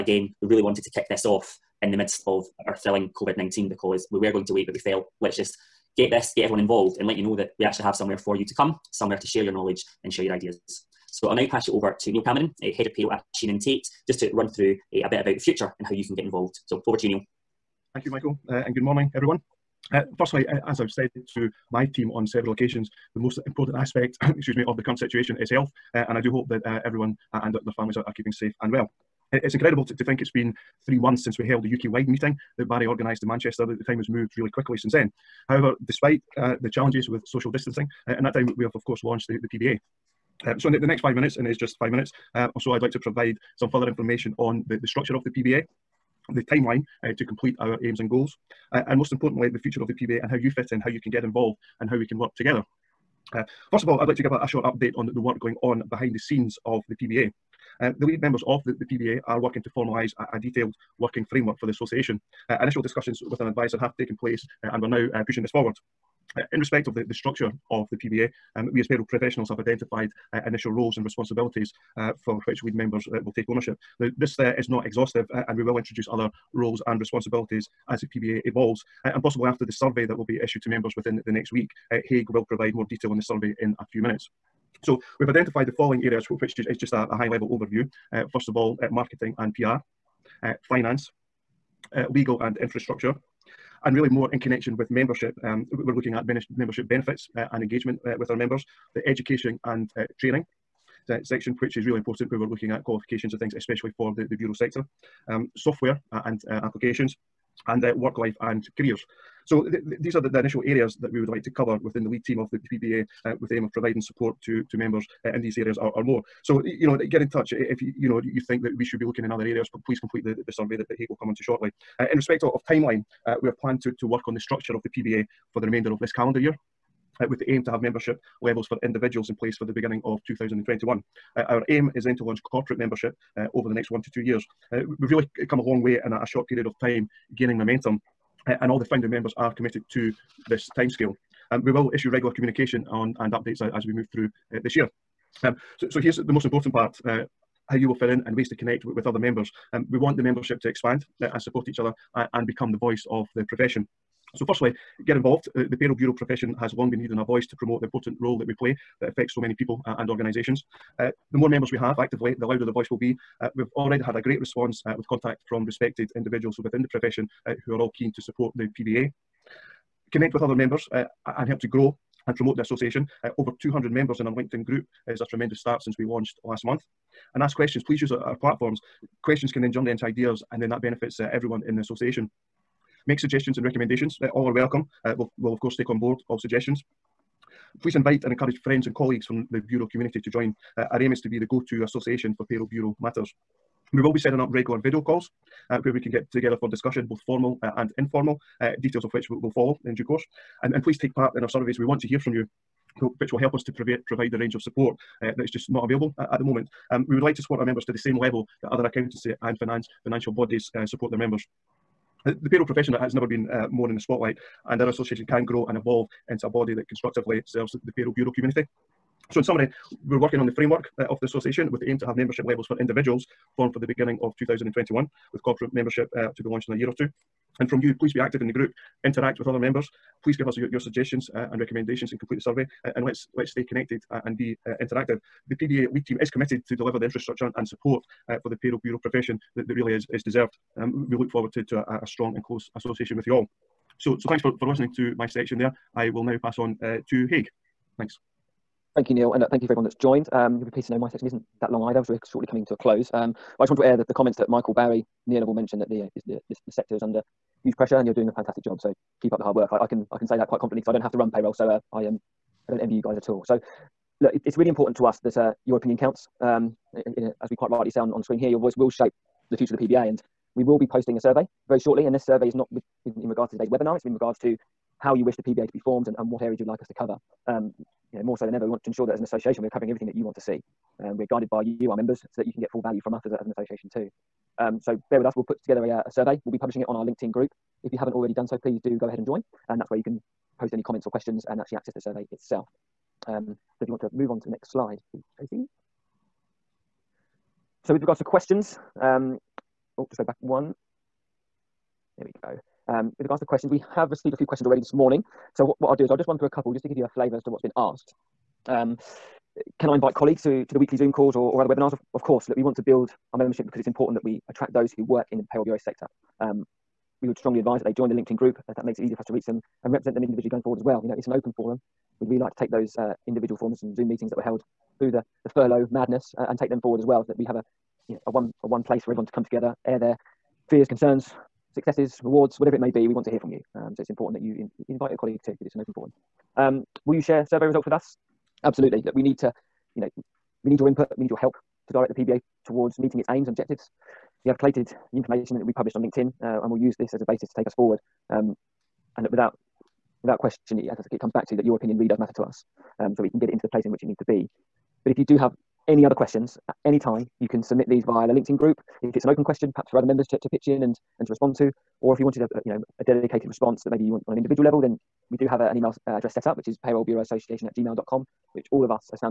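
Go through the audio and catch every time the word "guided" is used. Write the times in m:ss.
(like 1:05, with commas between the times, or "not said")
4:41.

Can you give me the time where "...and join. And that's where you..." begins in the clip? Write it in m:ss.
4:49.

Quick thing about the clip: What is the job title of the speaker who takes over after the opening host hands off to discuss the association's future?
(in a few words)
Head of Payroll.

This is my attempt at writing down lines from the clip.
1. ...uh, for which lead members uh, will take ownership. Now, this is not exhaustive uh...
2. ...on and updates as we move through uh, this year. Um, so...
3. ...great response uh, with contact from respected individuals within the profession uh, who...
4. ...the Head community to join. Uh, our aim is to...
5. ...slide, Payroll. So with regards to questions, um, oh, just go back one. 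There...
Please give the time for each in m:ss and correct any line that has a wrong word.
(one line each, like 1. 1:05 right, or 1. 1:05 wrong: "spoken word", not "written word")
1. 1:11 right
2. 2:22 right
3. 2:44 right
4. 3:09 wrong: "Bureau", not "Head"
5. 4:54 wrong: "Tracy", not "Payroll".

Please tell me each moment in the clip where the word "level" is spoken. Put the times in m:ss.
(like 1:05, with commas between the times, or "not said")
1:27, 2:08, 3:28, 3:42, 6:04.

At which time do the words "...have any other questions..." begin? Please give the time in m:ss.
5:55.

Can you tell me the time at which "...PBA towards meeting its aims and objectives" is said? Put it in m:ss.
5:42.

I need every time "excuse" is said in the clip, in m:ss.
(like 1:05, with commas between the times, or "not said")
0:24.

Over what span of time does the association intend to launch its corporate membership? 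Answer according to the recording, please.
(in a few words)
1 to 2 years.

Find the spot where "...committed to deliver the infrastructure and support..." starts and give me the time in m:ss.
3:56.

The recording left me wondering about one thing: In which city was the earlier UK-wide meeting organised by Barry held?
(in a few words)
Manchester.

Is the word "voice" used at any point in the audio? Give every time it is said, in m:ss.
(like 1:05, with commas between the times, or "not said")
2:32, 2:37, 2:42, 4:28.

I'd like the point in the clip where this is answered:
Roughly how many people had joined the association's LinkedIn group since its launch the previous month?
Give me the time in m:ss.
2:53.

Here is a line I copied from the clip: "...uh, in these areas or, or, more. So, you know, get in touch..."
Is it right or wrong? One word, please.
right.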